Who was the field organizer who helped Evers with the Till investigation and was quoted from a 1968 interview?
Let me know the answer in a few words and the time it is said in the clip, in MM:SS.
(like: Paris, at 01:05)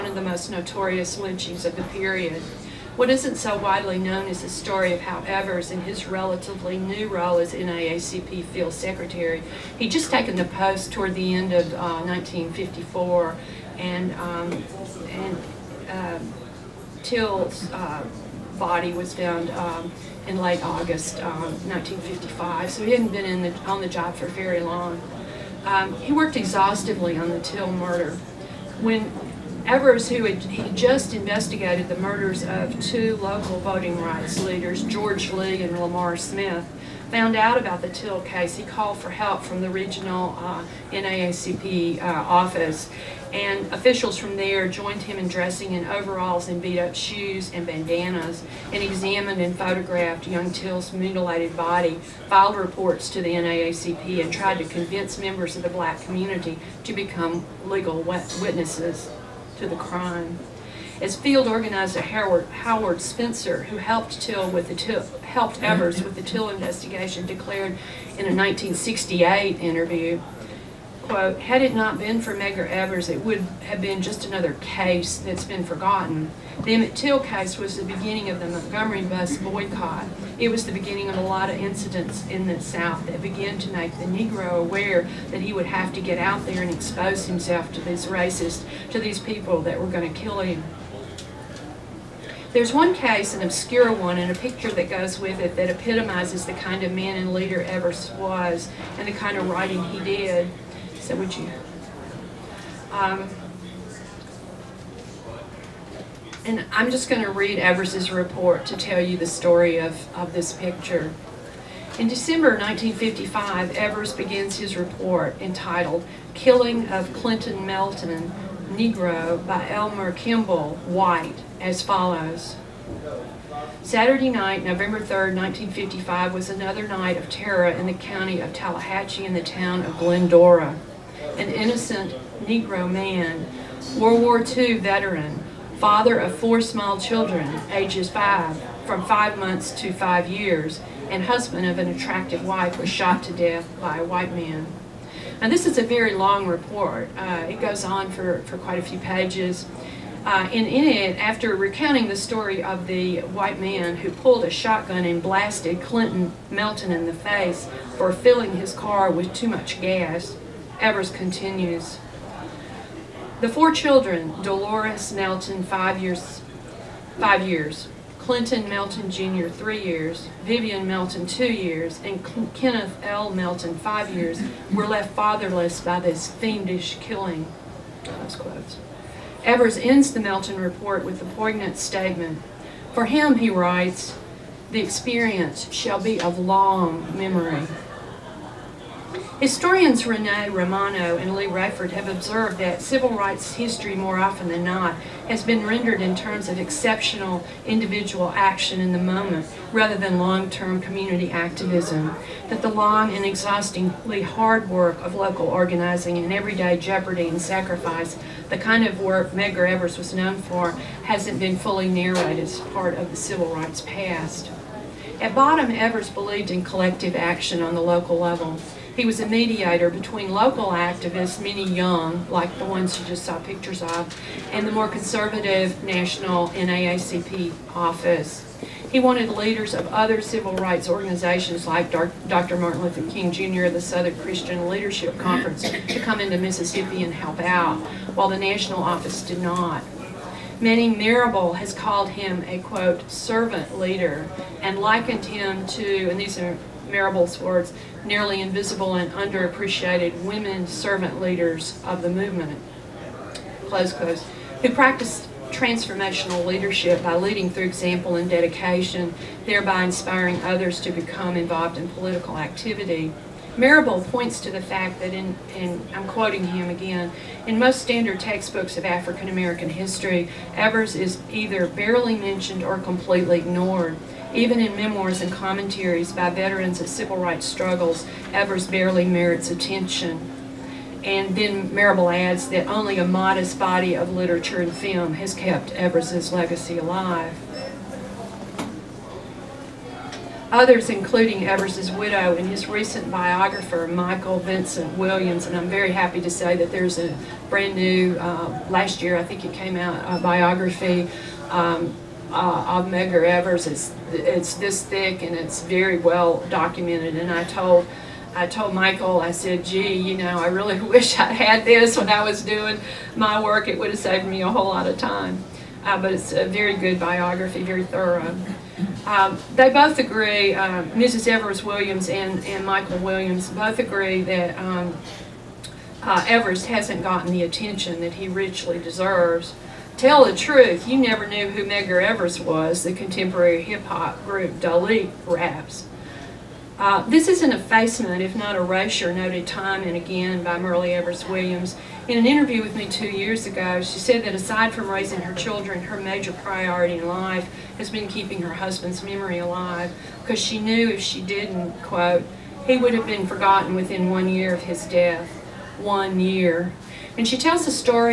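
Howard Spencer, at 01:02.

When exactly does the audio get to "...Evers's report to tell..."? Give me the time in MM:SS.
01:47.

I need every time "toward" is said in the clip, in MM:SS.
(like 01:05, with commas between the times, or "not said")
00:10.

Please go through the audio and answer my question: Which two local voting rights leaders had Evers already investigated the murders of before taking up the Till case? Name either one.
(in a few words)
George Lee.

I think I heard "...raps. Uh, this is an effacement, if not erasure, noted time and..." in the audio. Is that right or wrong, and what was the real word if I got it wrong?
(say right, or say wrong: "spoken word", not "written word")
right.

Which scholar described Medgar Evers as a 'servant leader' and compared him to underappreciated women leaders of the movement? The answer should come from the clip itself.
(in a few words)
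Manning Marable.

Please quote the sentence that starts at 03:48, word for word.
He wanted leaders of other civil rights organizations like Dr.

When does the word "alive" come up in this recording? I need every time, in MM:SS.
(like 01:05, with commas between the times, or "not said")
04:46, 05:49.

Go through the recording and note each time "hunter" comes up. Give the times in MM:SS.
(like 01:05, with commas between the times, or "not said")
not said.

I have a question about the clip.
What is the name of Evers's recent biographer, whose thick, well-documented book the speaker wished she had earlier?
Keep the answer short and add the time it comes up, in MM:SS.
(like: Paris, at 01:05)
Michael Vincent Williams, at 04:53.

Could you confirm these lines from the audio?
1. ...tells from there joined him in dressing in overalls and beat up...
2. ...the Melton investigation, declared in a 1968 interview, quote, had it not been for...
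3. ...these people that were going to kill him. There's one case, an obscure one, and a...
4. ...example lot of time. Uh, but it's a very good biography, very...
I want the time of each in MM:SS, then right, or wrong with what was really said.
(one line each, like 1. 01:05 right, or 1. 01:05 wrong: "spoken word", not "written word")
1. 00:43 wrong: "officials", not "tells"
2. 01:06 wrong: "Till", not "Melton"
3. 01:28 right
4. 05:14 wrong: "whole", not "example".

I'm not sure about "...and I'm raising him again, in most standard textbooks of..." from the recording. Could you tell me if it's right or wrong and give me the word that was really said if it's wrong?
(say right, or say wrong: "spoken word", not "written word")
wrong: "quoting", not "raising".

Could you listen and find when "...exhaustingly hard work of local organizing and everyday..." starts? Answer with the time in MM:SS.
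03:23.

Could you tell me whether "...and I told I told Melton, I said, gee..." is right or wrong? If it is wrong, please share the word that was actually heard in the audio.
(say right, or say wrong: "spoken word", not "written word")
wrong: "Michael", not "Melton".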